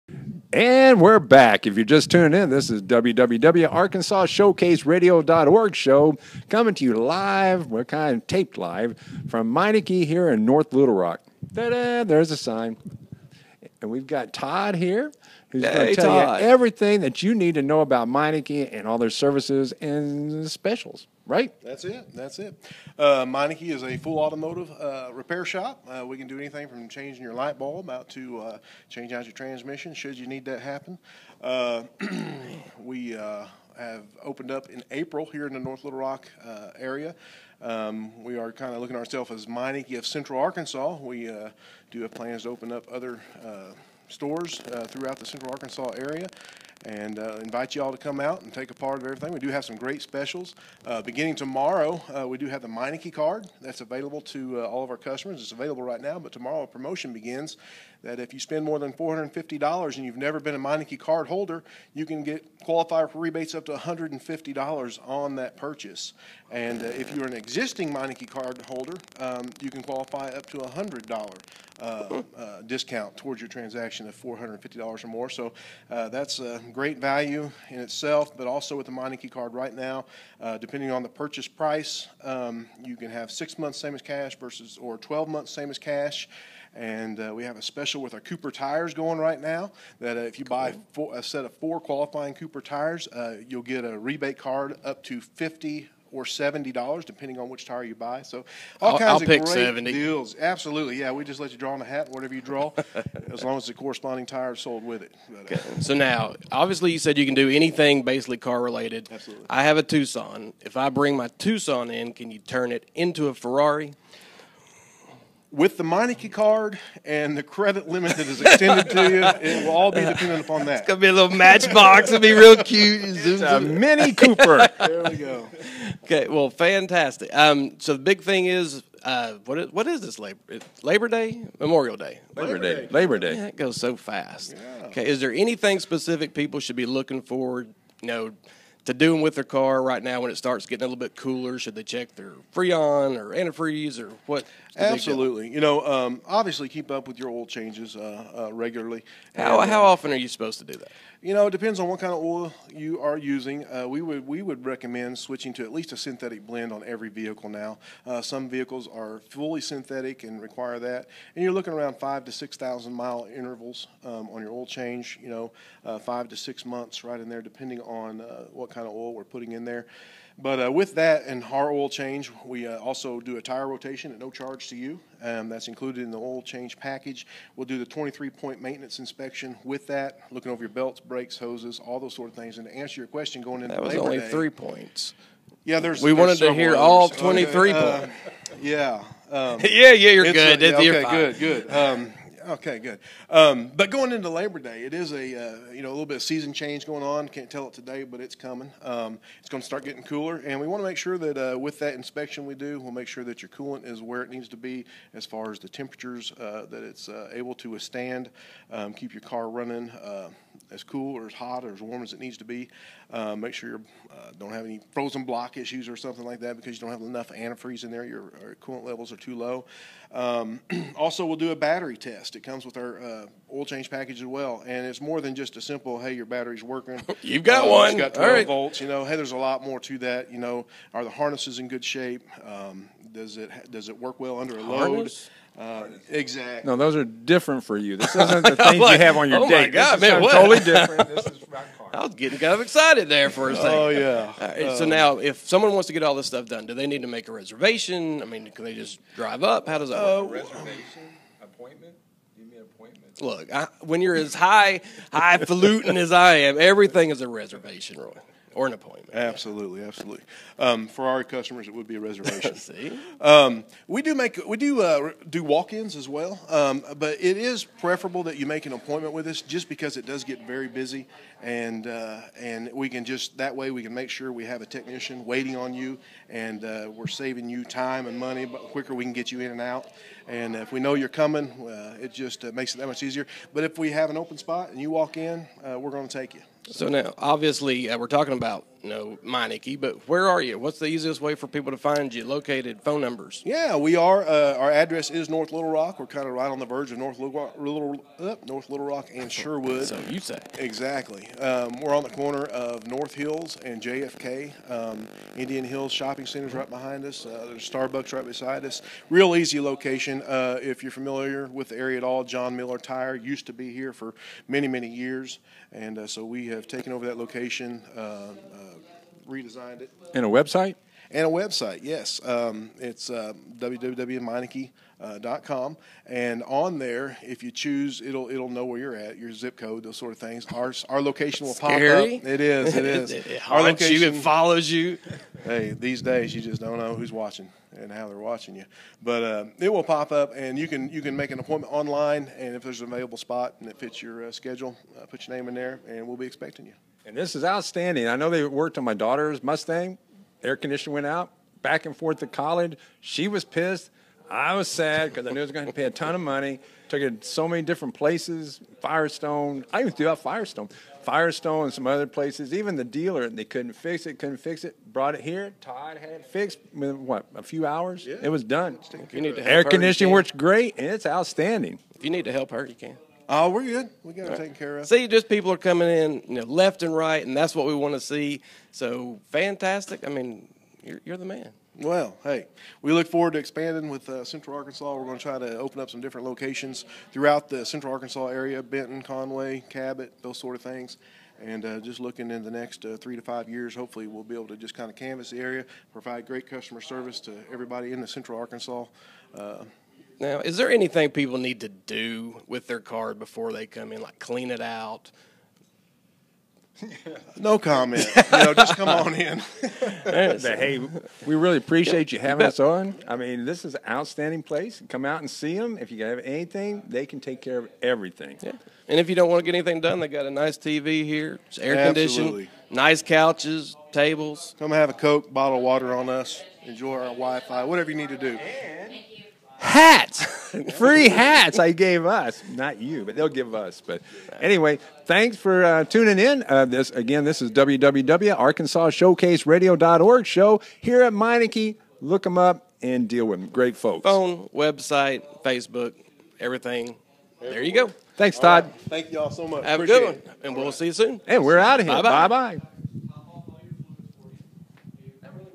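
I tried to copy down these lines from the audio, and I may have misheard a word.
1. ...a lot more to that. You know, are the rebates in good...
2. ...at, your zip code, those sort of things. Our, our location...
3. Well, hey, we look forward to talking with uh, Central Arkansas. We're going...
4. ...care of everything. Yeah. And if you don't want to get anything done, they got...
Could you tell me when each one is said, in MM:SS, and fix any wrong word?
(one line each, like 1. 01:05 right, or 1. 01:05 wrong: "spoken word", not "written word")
1. 03:49 wrong: "harnesses", not "rebates"
2. 05:28 right
3. 06:21 wrong: "expanding", not "talking"
4. 06:57 right.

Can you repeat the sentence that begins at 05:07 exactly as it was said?
Uh, there's Starbucks right beside us.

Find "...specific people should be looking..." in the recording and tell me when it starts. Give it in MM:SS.
02:15.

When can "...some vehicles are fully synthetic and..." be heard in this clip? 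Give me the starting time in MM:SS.
02:38.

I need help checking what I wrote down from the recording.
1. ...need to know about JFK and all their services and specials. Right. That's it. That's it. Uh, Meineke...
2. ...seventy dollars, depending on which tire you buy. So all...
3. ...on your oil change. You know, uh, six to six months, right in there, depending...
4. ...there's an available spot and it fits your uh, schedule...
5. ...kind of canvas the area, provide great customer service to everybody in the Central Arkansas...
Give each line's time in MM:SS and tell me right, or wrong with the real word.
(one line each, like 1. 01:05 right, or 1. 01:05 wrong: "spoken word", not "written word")
1. 00:17 wrong: "Meineke", not "JFK"
2. 01:36 right
3. 02:44 wrong: "five", not "six"
4. 05:42 right
5. 06:34 right.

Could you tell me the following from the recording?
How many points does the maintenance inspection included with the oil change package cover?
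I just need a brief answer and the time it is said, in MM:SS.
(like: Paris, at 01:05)
23, at 02:57.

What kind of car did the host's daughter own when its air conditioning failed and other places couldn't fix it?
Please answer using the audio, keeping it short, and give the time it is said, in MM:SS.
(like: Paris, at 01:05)
Mustang, at 05:49.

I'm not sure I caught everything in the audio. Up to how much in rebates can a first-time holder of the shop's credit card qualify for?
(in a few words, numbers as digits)
$150.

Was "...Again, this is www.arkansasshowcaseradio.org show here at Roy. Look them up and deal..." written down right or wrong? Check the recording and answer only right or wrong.
wrong.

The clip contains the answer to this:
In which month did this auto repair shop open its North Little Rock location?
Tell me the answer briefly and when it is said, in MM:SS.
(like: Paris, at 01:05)
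April, at 00:34.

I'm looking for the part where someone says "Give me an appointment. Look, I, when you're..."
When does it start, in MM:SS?
04:12.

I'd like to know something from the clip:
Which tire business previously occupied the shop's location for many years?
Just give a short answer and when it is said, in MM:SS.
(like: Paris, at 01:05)
John Miller Tire, at 05:12.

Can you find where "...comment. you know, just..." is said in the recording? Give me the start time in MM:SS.
06:47.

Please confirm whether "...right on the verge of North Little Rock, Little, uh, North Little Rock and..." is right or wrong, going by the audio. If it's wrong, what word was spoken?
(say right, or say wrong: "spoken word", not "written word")
right.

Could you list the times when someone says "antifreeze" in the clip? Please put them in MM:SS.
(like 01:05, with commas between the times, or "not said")
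02:23, 03:37.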